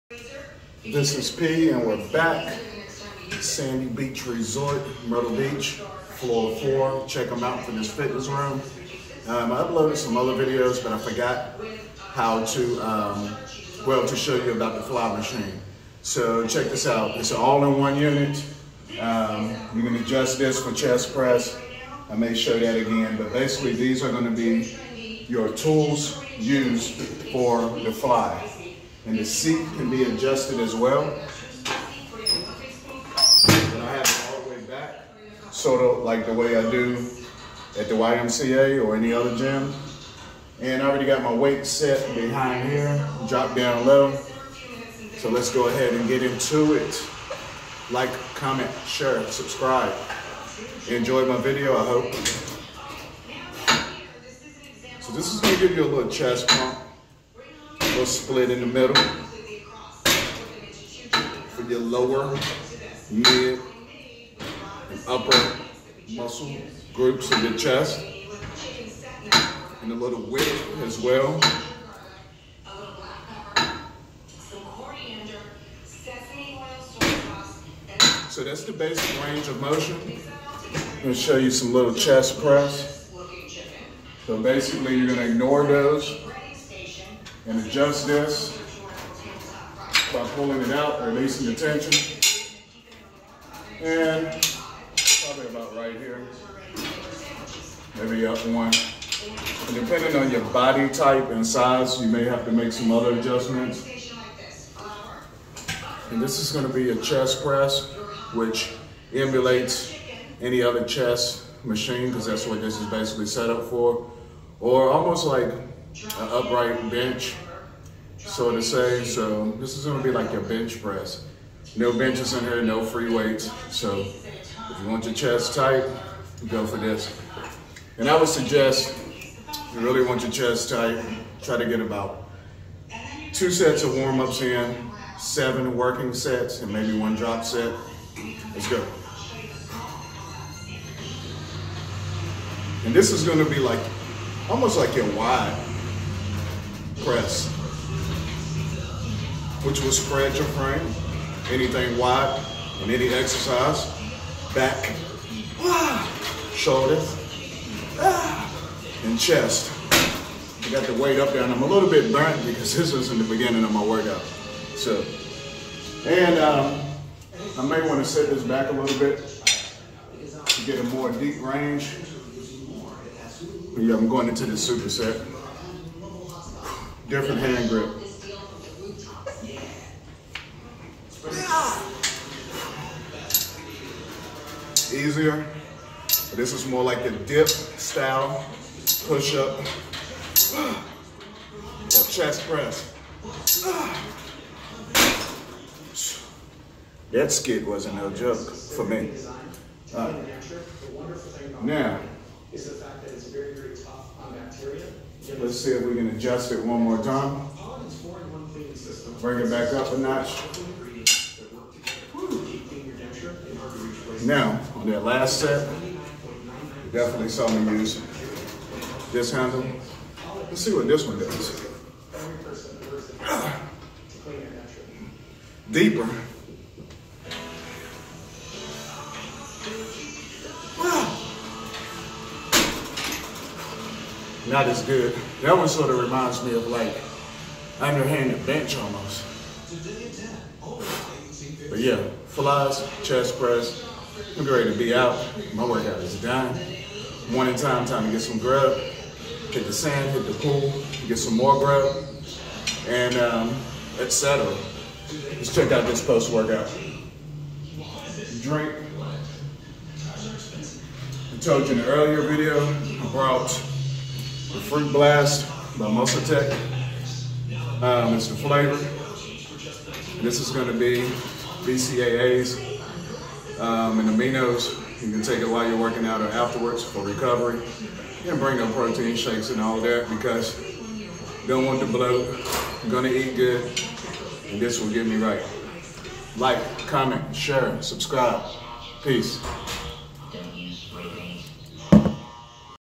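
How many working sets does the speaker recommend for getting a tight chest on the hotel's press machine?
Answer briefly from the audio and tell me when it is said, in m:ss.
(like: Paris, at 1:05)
7, at 2:15.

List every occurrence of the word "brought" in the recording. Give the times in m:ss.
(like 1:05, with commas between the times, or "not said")
4:23.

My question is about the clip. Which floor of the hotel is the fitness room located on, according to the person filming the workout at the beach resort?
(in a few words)
4.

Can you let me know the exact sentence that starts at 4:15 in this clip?
Let's check out this post workout.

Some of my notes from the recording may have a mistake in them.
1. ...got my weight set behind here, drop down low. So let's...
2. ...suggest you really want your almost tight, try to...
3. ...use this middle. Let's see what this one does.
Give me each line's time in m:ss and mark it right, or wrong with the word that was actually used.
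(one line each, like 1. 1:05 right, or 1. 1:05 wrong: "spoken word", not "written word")
1. 0:41 right
2. 2:08 wrong: "chest", not "almost"
3. 3:37 wrong: "handle", not "middle".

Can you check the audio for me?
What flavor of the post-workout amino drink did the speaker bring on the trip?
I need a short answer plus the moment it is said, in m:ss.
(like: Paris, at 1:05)
Fruit Blast, at 4:24.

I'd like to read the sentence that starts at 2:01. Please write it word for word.
No benches in here, no free weights.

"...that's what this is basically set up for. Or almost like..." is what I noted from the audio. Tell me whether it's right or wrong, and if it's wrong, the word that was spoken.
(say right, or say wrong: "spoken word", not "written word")
right.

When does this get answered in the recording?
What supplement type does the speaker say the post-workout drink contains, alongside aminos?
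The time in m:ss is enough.
4:31.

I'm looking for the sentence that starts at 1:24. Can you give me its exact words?
So basically you're gonna ignore those and adjust this by pulling it out releasing the tension.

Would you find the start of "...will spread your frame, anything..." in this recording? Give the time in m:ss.
2:29.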